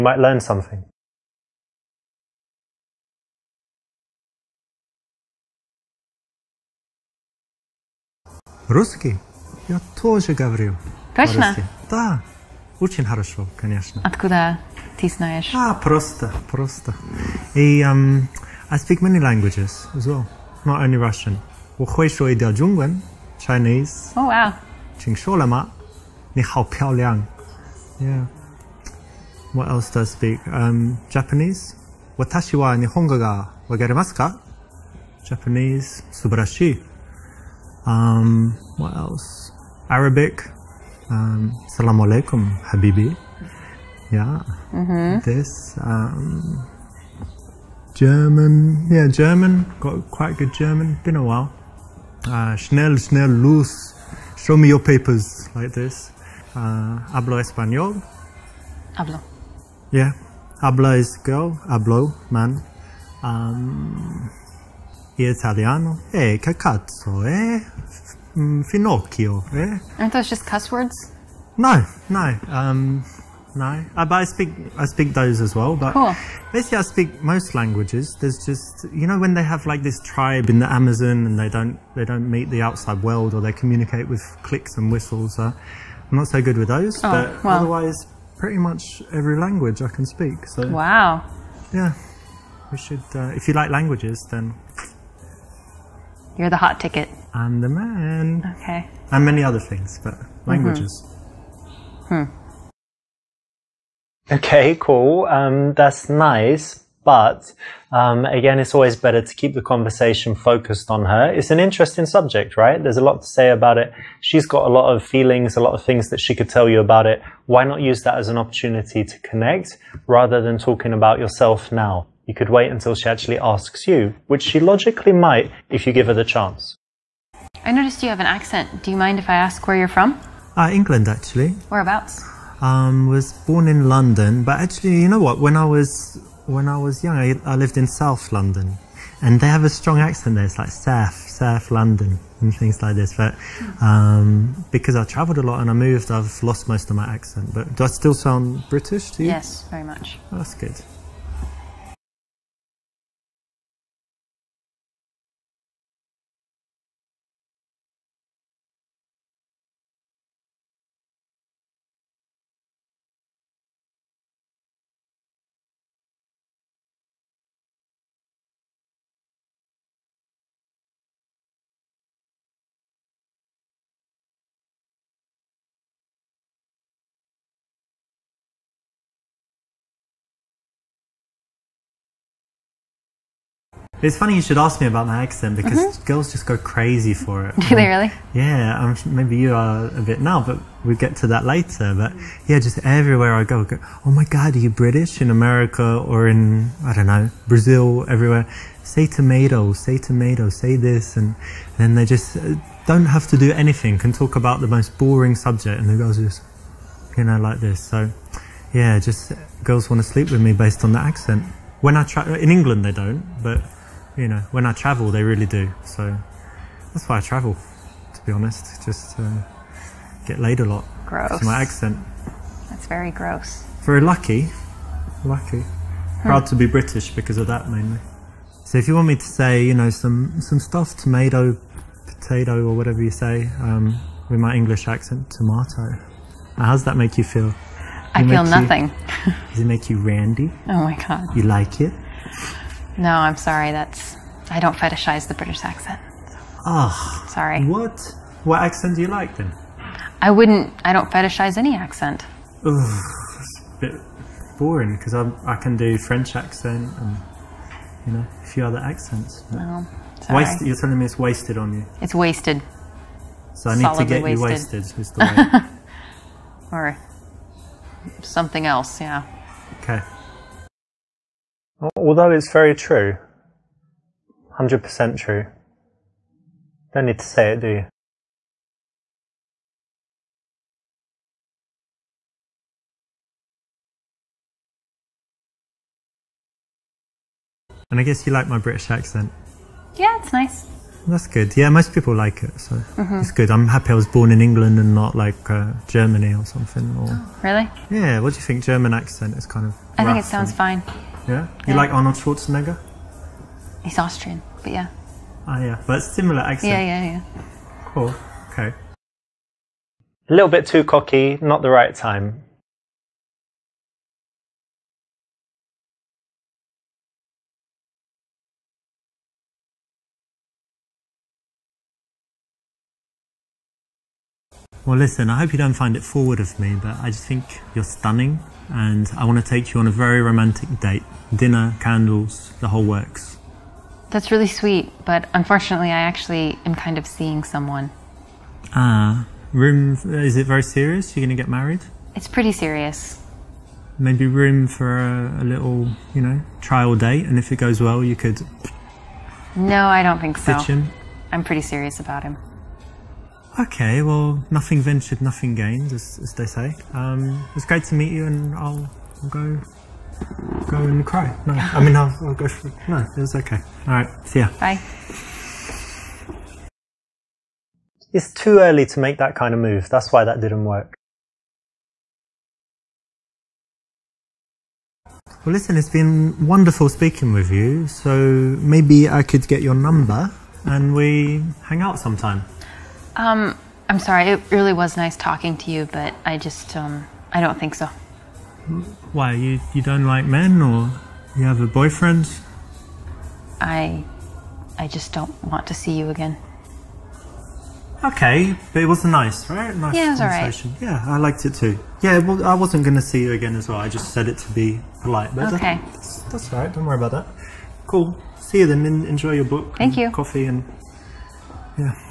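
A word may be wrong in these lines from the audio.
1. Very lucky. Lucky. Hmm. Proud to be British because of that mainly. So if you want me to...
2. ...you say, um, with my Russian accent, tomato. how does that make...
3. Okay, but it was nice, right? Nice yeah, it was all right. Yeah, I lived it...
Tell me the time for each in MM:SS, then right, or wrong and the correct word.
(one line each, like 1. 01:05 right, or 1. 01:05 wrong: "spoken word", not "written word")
1. 03:43 right
2. 03:53 wrong: "English", not "Russian"
3. 06:38 wrong: "liked", not "lived".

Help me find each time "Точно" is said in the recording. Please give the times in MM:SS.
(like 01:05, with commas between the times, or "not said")
00:11.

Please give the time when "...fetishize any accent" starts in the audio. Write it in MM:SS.
04:11.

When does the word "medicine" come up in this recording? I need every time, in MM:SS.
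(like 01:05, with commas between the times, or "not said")
not said.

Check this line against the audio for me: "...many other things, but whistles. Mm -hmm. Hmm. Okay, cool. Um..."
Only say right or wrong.
wrong.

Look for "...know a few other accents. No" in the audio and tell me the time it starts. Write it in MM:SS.
04:18.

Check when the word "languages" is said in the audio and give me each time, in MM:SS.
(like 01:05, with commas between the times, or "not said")
00:19, 01:17, 01:29, 01:33, 01:40.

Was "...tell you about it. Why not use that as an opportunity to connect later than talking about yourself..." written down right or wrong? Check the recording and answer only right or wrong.
wrong.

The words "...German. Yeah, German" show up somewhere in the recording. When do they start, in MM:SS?
00:47.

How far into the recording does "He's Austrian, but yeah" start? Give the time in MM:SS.
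05:03.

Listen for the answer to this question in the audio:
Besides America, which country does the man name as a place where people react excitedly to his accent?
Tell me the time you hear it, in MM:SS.
03:17.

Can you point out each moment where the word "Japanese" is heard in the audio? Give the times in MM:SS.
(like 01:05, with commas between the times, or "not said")
00:31, 00:35.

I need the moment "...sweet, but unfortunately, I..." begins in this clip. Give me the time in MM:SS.
05:34.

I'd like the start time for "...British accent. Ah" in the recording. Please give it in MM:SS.
04:05.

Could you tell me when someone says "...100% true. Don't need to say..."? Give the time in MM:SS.
04:34.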